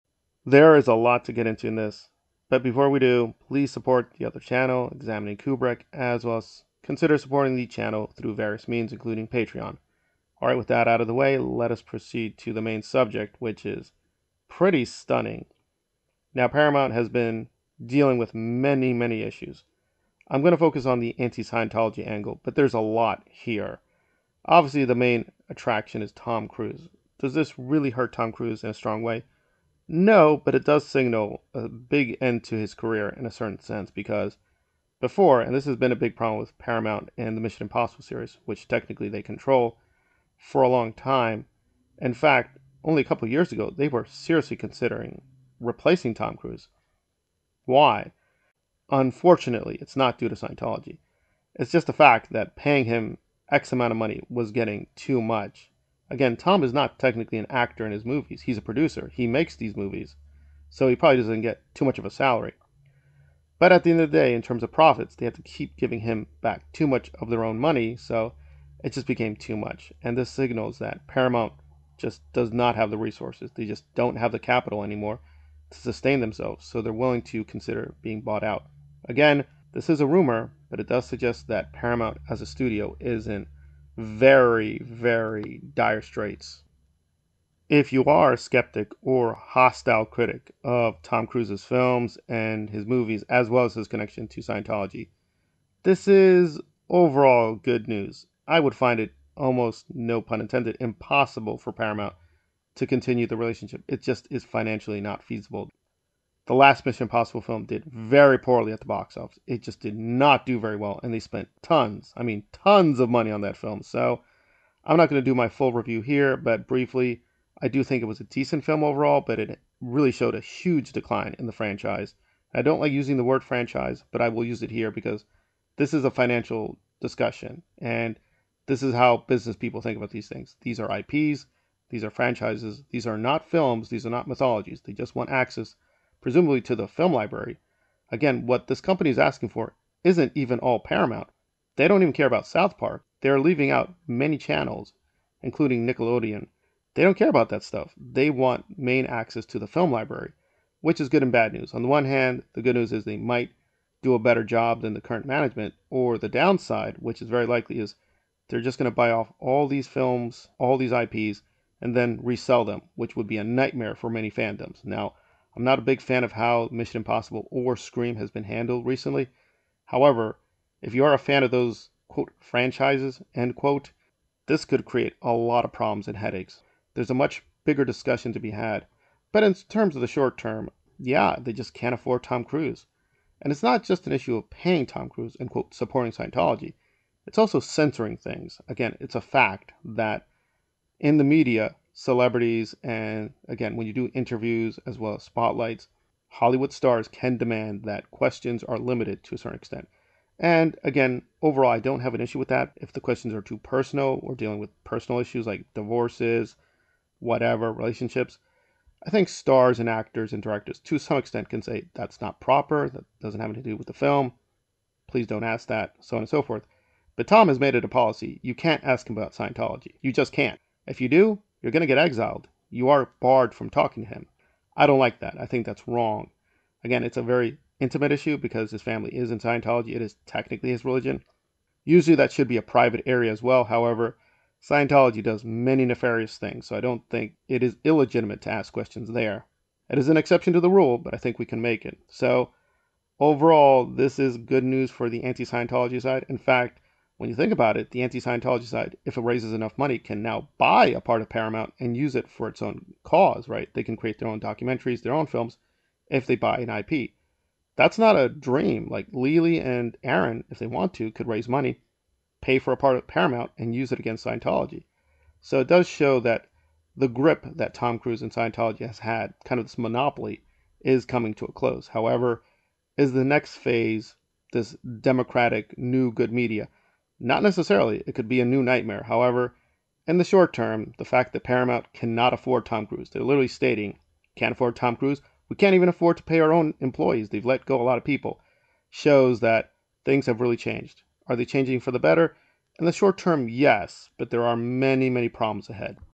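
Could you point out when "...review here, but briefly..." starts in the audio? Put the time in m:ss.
1:55.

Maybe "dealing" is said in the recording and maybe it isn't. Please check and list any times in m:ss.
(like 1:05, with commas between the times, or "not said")
0:17, 3:24.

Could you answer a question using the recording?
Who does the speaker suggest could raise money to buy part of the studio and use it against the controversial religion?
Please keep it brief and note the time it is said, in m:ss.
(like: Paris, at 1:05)
Lily and Aaron, at 4:19.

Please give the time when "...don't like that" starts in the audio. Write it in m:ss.
3:44.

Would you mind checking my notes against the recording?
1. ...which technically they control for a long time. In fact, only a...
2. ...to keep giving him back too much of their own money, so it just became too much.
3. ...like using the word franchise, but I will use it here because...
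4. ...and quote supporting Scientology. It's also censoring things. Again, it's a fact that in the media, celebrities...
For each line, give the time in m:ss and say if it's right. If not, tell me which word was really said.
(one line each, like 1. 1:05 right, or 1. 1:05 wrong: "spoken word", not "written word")
1. 0:38 right
2. 1:05 right
3. 2:02 right
4. 3:05 right.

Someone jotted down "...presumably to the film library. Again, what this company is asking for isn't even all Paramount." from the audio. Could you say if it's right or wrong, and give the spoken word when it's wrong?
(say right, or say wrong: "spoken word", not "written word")
right.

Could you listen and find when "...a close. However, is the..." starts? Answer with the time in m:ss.
4:31.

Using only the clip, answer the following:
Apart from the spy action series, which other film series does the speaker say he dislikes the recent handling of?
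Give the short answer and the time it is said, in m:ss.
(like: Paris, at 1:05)
Scream, at 2:47.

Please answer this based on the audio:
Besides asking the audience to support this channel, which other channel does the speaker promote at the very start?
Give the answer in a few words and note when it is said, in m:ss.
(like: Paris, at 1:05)
Examining Kubrick, at 0:04.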